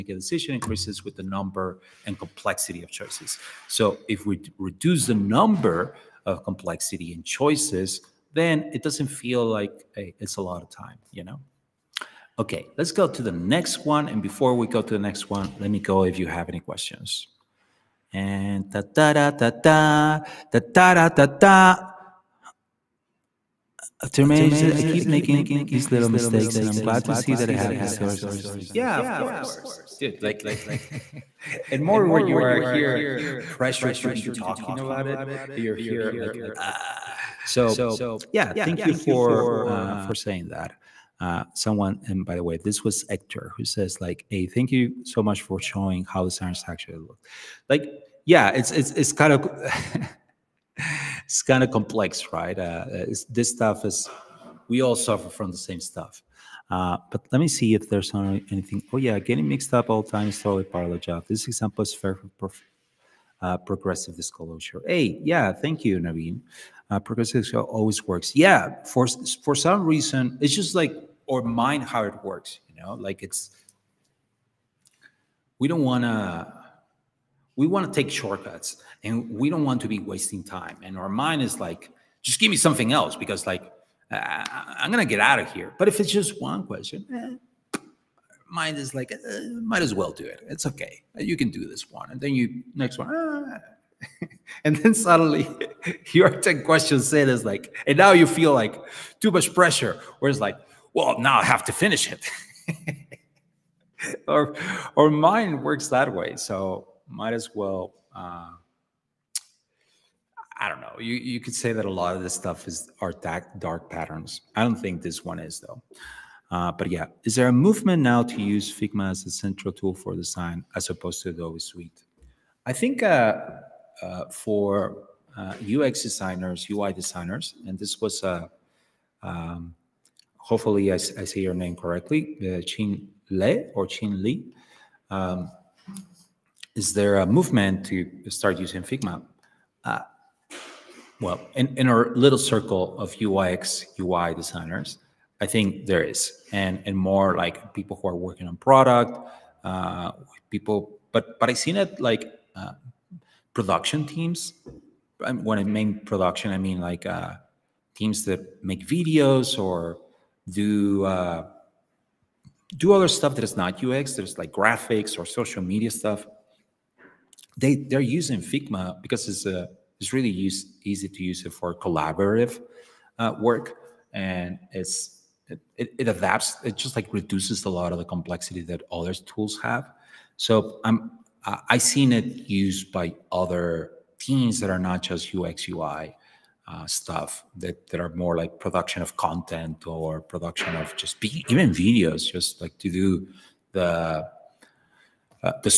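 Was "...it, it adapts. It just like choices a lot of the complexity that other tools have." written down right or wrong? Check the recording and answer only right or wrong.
wrong.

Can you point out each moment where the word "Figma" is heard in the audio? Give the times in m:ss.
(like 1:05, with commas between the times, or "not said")
1:58, 2:18, 2:48.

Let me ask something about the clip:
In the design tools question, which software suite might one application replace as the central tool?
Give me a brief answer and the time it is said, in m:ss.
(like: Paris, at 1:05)
Adobe Suite, at 2:01.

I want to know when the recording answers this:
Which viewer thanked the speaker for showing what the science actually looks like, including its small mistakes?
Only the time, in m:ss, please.
0:43.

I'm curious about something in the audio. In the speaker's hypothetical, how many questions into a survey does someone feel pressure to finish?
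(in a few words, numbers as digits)
10.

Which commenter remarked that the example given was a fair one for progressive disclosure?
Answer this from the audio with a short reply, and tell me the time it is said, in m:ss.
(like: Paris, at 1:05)
Naveen, at 1:05.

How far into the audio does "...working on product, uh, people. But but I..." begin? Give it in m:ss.
2:28.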